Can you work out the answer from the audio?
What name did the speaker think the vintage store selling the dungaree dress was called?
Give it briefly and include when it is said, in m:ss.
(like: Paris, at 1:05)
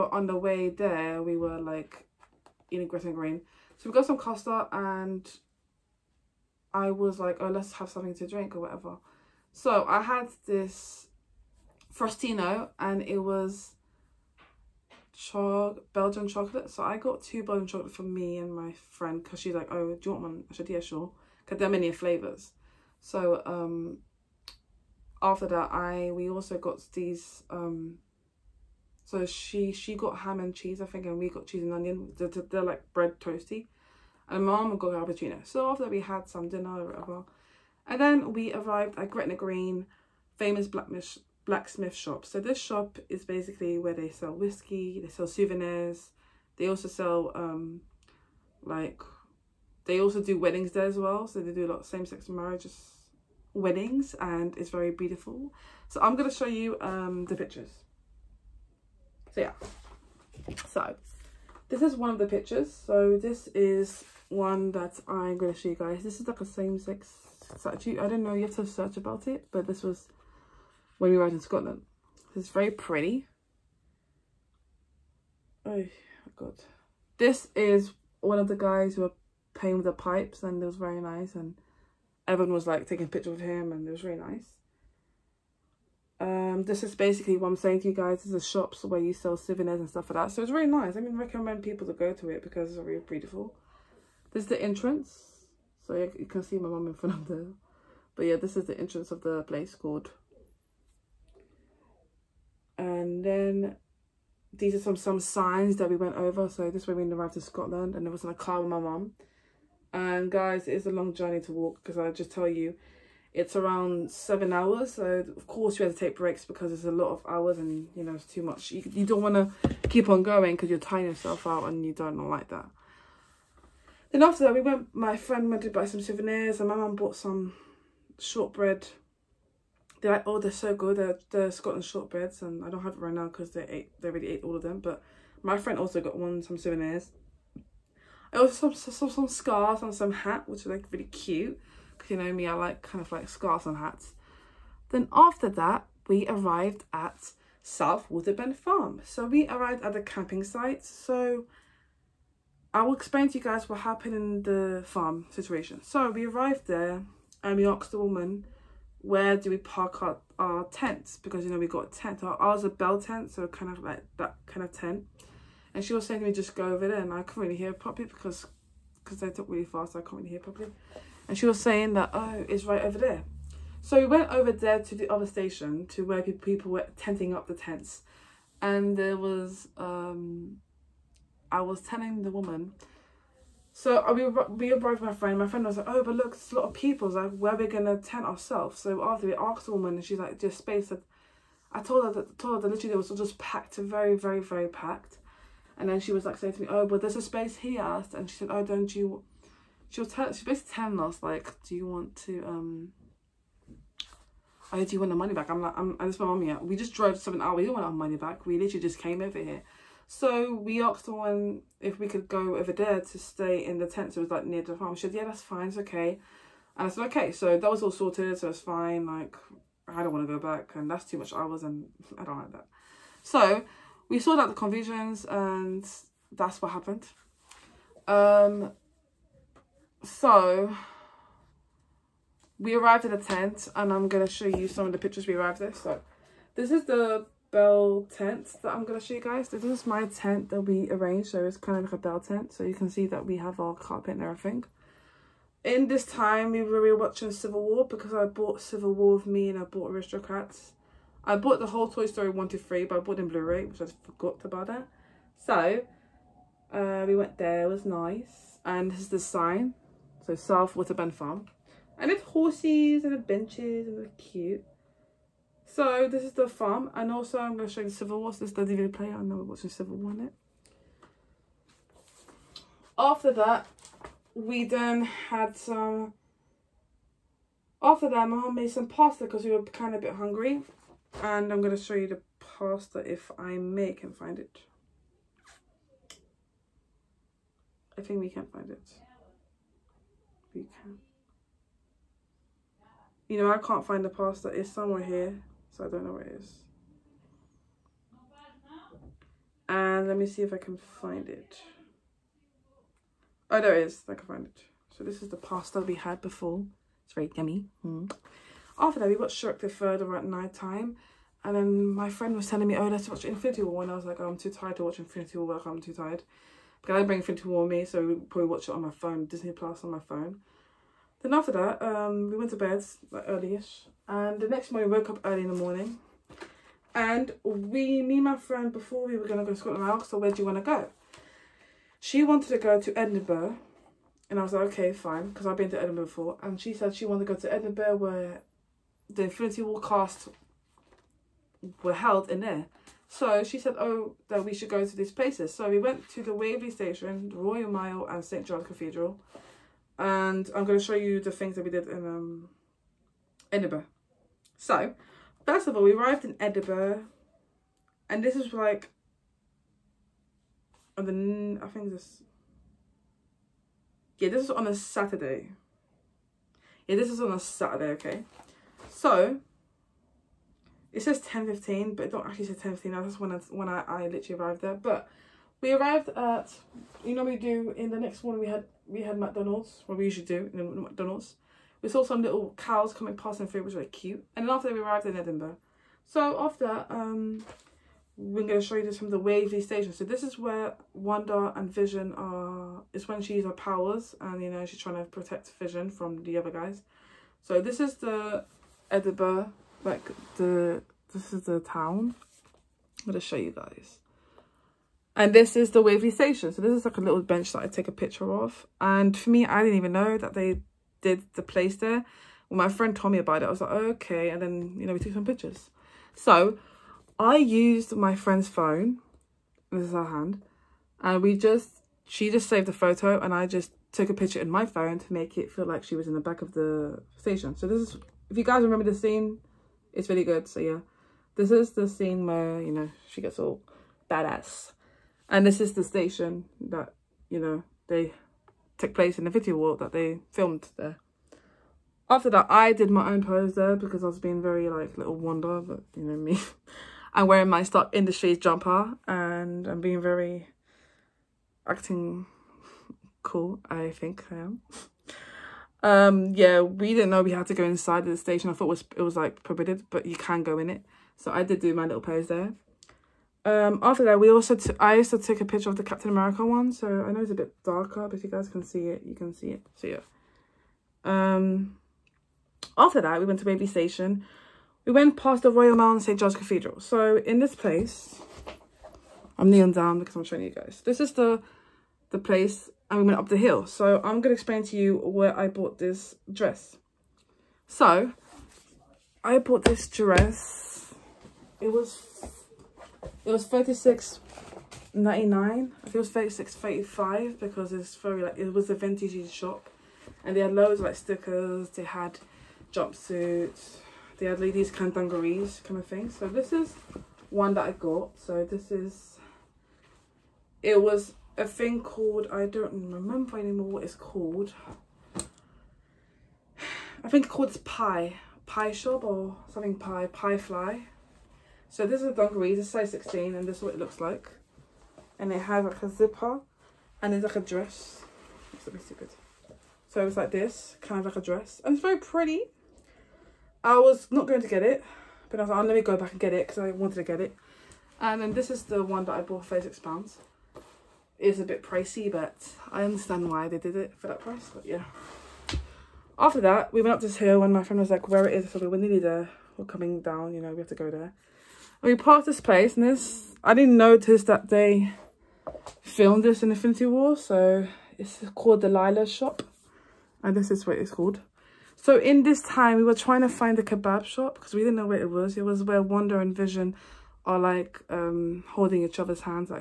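Pie Fly, at 8:39.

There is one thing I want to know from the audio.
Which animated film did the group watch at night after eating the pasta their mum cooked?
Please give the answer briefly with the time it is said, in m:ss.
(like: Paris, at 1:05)
Shrek the Third, at 5:09.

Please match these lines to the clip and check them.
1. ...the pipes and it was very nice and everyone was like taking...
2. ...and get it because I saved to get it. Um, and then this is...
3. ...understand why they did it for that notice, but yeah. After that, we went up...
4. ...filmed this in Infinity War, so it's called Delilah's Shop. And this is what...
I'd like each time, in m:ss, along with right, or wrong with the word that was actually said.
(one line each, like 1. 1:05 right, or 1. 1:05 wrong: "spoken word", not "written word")
1. 1:19 right
2. 8:56 wrong: "wanted", not "saved"
3. 9:02 wrong: "price", not "notice"
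4. 9:15 right.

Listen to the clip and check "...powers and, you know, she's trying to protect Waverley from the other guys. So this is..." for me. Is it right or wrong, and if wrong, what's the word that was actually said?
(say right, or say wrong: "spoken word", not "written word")
wrong: "Vision", not "Waverley".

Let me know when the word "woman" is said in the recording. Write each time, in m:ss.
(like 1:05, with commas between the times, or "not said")
2:37, 3:02, 3:09.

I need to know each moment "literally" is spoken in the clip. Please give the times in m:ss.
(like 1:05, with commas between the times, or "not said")
3:12, 3:28, 6:14.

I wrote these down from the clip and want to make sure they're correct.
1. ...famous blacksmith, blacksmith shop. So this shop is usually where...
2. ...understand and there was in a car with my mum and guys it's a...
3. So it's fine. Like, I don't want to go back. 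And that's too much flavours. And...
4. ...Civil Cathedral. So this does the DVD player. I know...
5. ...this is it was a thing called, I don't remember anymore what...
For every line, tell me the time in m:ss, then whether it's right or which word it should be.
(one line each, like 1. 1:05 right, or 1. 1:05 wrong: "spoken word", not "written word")
1. 0:40 wrong: "basically", not "usually"
2. 1:47 wrong: "scotland", not "understand"
3. 3:38 wrong: "hours", not "flavours"
4. 4:27 wrong: "War", not "Cathedral"
5. 8:28 right.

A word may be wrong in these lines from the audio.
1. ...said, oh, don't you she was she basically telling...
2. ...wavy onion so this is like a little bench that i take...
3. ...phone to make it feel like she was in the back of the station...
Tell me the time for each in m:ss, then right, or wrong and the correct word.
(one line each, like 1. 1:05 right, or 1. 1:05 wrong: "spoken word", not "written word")
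1. 3:18 right
2. 6:45 wrong: "station", not "onion"
3. 7:04 right.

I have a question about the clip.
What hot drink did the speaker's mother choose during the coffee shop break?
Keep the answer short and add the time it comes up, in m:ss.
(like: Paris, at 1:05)
Cappuccino, at 0:34.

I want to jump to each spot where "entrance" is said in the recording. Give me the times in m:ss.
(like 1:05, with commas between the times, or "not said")
1:34, 1:38.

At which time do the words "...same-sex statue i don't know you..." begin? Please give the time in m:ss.
1:06.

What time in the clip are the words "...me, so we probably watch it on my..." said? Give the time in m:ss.
5:17.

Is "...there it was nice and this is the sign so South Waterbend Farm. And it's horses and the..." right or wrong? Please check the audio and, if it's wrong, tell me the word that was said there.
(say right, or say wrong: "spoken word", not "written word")
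right.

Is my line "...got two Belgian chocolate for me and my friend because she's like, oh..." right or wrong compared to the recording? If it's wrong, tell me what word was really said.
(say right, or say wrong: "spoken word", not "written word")
right.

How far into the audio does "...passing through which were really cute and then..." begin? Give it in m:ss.
6:23.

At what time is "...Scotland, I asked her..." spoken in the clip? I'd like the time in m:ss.
5:29.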